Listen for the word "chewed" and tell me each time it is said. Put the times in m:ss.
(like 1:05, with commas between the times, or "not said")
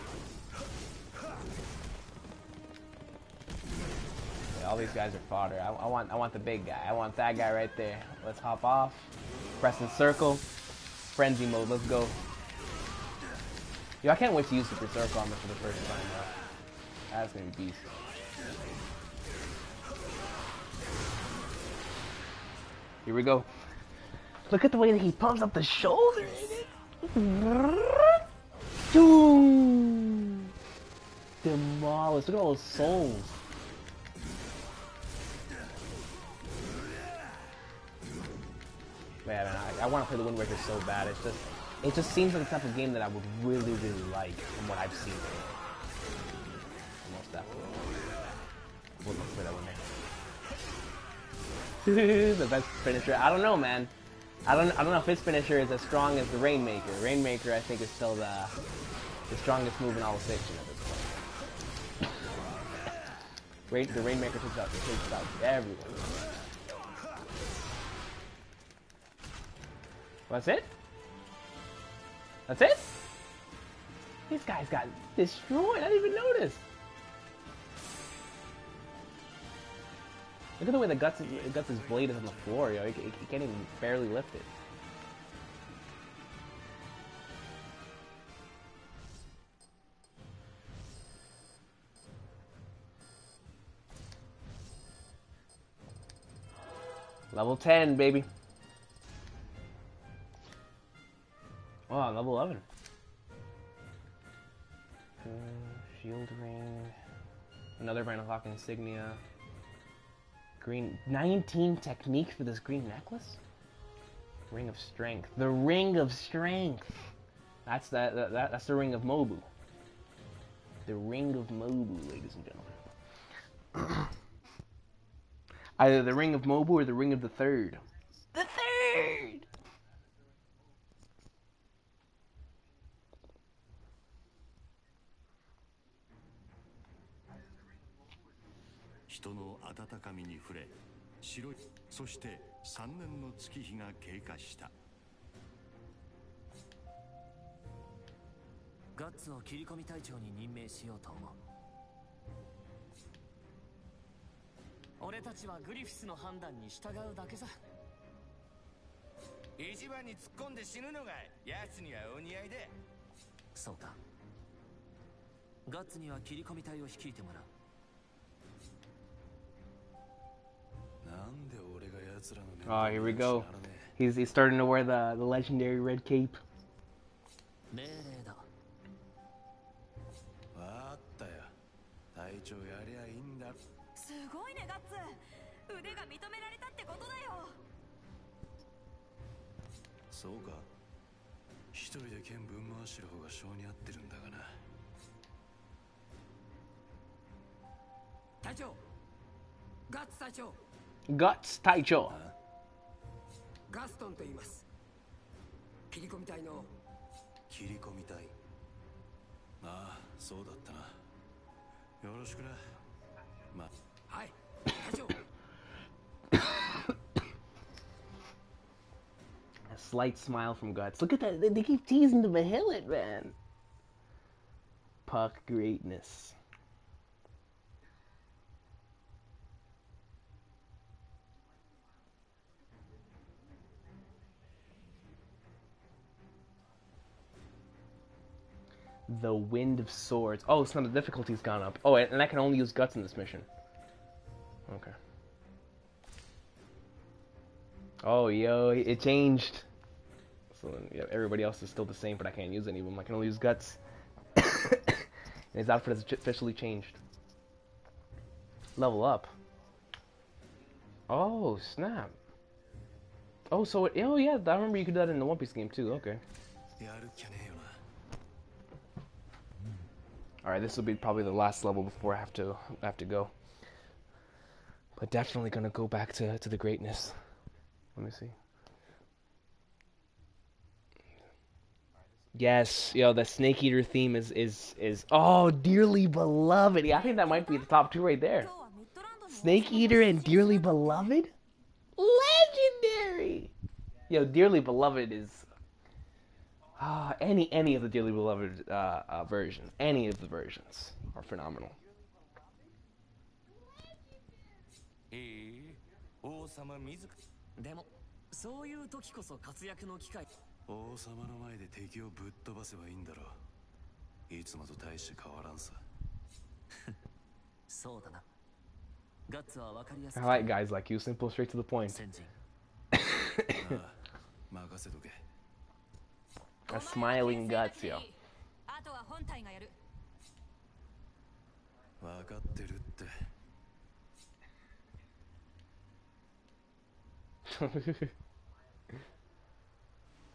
not said.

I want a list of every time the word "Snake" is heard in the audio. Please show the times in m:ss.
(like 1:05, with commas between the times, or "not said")
4:43, 4:49.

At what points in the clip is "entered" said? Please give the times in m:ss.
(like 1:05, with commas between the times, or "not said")
not said.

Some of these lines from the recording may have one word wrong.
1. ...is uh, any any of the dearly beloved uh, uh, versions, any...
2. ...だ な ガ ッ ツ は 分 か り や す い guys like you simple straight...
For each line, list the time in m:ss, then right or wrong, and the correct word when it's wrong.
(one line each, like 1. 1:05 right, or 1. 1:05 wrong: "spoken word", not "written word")
1. 4:55 right
2. 5:18 right.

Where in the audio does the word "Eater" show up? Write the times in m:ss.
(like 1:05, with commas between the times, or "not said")
4:43, 4:49.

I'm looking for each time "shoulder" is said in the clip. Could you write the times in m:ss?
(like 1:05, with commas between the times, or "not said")
0:25.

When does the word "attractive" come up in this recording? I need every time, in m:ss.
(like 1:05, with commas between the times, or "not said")
not said.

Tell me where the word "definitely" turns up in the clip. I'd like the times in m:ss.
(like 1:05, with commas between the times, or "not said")
0:47, 4:35.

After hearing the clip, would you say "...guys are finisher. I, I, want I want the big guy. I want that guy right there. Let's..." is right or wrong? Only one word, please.
wrong.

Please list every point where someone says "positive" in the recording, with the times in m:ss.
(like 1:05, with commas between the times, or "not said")
not said.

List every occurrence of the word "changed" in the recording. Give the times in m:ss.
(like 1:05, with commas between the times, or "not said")
4:09, 4:16.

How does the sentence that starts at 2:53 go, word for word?
He's he's starting to wear the the legendary red cape.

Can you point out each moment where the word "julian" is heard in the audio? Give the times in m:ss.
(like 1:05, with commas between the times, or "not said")
not said.